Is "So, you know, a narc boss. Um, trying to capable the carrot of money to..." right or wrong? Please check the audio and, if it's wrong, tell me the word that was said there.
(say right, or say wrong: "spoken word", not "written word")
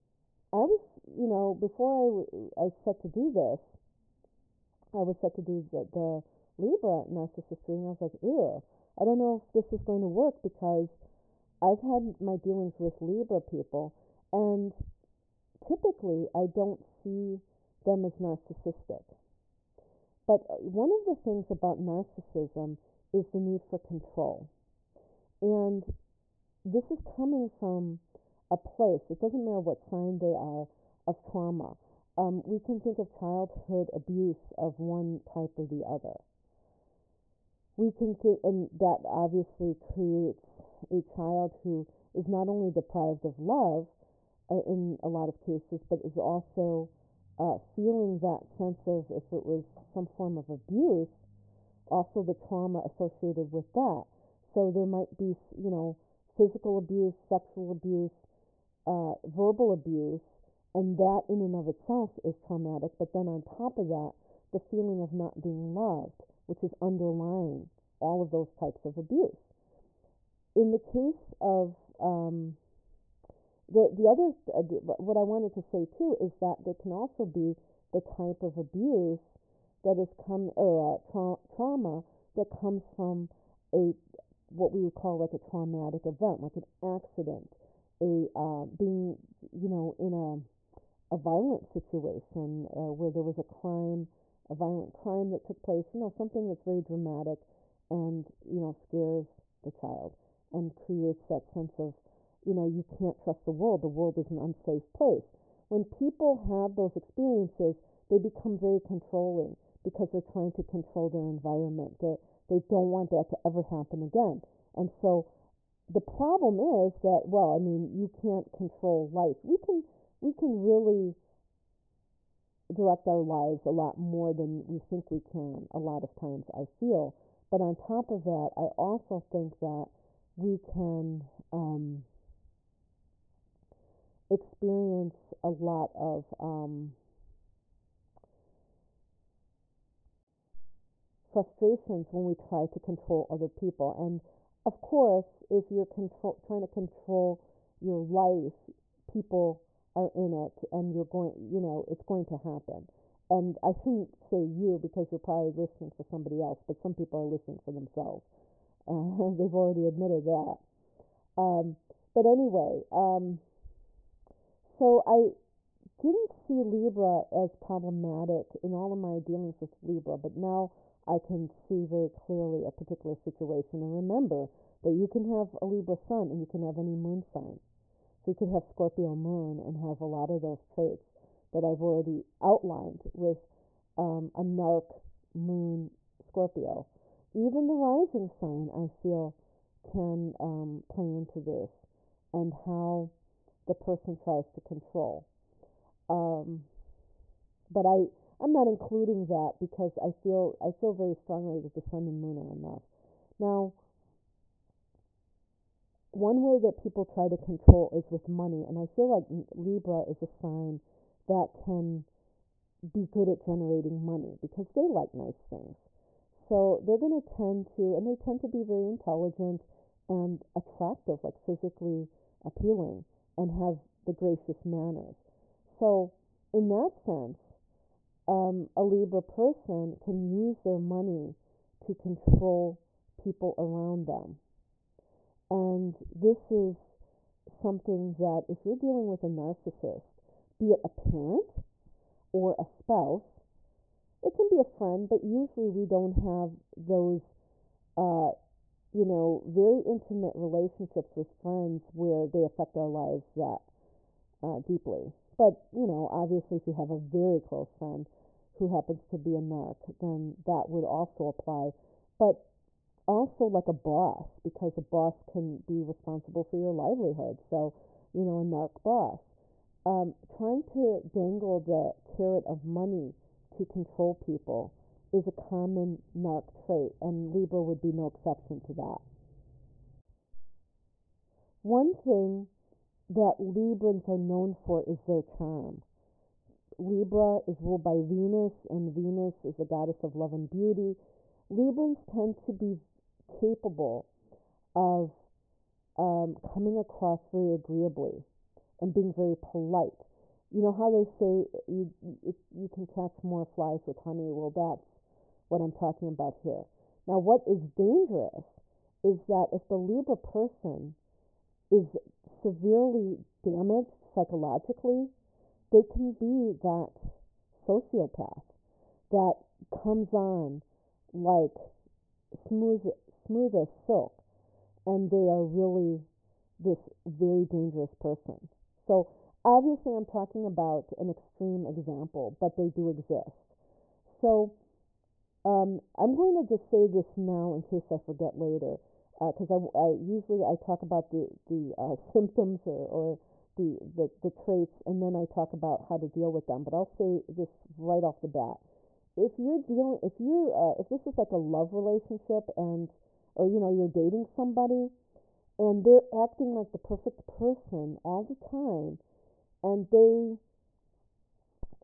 wrong: "dangle", not "capable".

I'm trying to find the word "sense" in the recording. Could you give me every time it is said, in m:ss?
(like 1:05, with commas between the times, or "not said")
0:48, 1:41, 3:46.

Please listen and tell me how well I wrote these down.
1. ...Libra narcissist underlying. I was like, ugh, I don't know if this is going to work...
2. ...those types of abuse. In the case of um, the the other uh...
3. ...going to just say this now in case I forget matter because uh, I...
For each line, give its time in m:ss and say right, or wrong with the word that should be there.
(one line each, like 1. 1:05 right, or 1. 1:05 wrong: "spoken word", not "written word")
1. 0:06 wrong: "reading", not "underlying"
2. 1:08 right
3. 5:36 wrong: "later", not "matter".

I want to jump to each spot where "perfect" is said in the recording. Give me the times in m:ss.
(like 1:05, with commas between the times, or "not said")
5:56.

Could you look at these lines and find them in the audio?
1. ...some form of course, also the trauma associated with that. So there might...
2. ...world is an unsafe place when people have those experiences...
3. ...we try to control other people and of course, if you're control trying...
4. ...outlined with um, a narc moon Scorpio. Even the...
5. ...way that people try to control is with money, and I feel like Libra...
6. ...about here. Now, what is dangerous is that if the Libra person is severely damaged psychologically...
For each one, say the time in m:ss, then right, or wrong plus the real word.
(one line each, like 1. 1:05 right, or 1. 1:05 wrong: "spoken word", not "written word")
1. 0:49 wrong: "abuse", not "course"
2. 1:43 right
3. 2:22 right
4. 3:02 right
5. 3:26 right
6. 5:06 right.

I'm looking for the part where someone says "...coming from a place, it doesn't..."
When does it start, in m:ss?
0:26.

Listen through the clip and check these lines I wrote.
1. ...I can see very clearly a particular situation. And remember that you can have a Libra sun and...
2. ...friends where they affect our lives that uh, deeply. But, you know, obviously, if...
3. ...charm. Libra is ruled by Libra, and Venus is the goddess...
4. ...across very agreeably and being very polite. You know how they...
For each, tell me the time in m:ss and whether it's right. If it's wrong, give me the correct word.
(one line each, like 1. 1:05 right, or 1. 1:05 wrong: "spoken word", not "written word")
1. 2:51 right
2. 4:11 right
3. 4:45 wrong: "Venus", not "Libra"
4. 4:56 right.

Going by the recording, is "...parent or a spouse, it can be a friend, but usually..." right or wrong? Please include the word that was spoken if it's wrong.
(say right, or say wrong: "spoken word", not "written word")
right.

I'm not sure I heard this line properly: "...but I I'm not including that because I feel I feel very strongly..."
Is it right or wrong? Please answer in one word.
right.